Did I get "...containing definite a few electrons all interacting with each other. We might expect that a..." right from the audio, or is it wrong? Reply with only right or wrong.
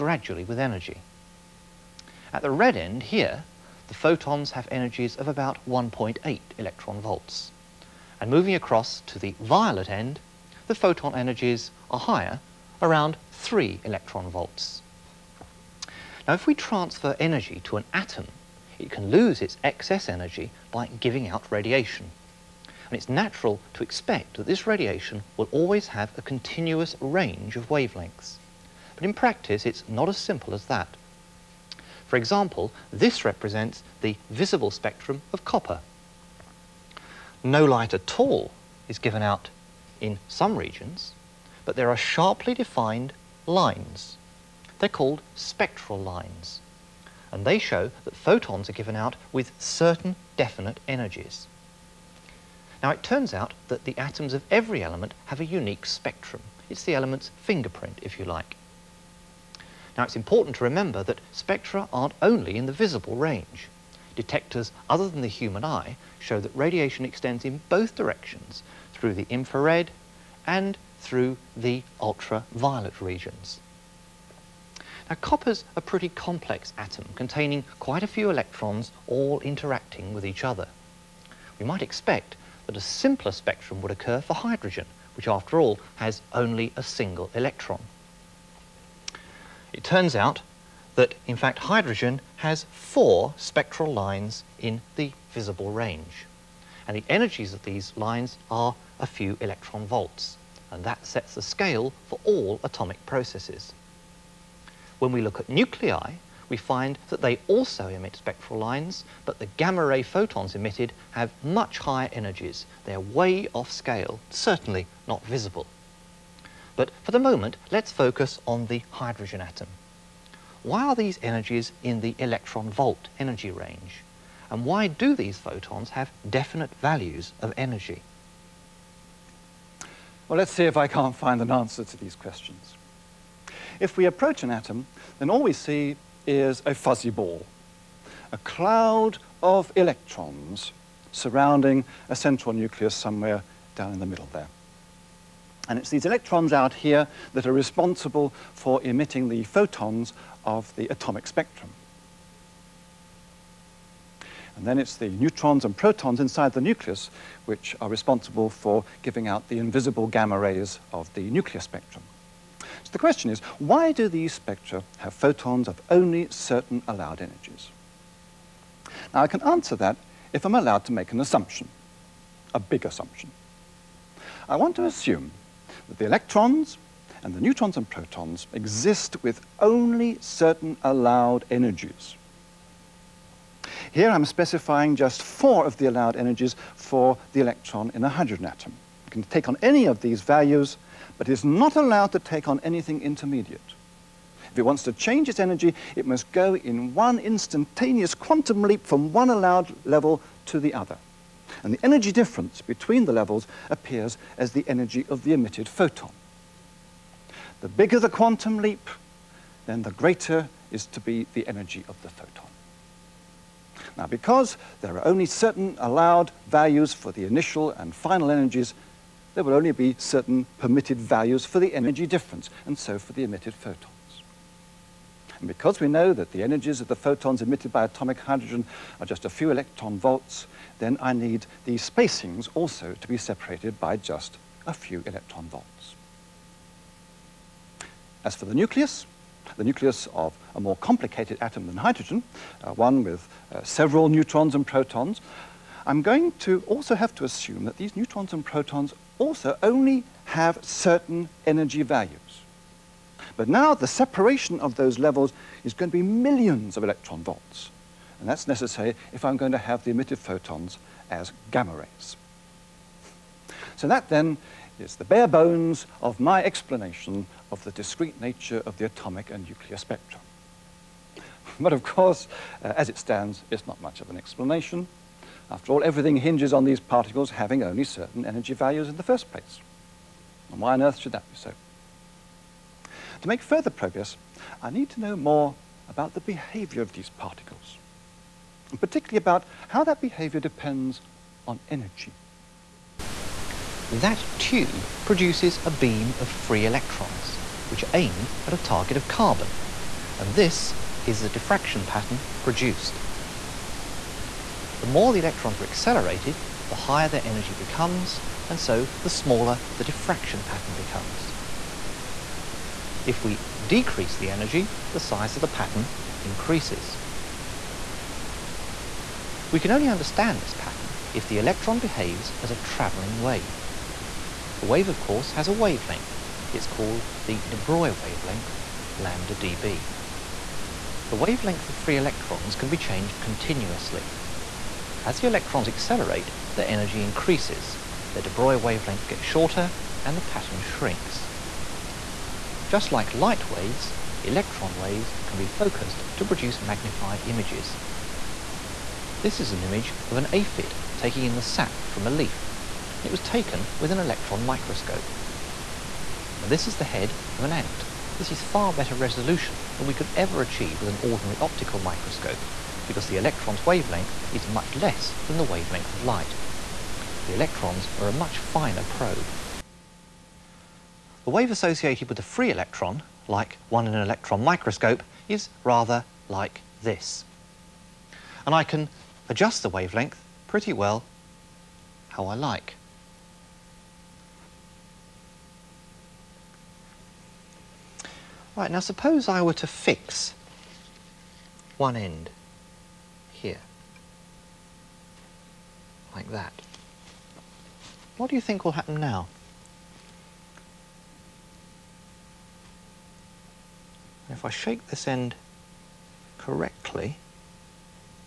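wrong.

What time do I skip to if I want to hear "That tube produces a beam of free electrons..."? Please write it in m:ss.
4:53.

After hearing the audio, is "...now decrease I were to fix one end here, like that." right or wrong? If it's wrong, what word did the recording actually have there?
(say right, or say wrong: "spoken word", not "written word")
wrong: "suppose", not "decrease".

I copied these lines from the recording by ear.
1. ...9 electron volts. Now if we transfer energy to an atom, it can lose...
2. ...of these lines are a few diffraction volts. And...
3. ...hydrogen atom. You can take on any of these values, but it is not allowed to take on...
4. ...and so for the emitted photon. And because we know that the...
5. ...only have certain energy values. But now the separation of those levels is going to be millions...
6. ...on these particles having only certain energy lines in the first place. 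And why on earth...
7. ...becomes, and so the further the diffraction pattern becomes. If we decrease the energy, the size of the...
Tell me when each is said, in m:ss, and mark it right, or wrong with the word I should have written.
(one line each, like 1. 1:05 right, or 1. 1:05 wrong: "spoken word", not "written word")
1. 0:13 wrong: "3", not "9"
2. 1:37 wrong: "electron", not "diffraction"
3. 3:08 right
4. 3:42 right
5. 4:09 right
6. 4:36 wrong: "values", not "lines"
7. 5:07 wrong: "smaller", not "further".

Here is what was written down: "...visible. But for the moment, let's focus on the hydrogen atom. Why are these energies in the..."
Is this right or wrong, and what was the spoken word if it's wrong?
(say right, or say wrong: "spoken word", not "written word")
right.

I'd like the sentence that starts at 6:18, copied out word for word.
And I can adjust the wavelength pretty well how I like.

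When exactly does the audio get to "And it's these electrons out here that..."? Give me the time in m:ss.
2:25.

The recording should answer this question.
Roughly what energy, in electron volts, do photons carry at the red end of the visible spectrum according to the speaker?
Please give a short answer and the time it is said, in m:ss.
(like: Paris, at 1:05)
1.8 electron volts, at 0:05.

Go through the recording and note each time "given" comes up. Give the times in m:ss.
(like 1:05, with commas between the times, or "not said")
0:38, 0:48.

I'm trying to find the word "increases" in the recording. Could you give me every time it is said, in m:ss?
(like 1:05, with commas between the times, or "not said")
5:16, 5:37.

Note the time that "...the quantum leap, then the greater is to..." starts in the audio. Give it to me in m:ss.
3:27.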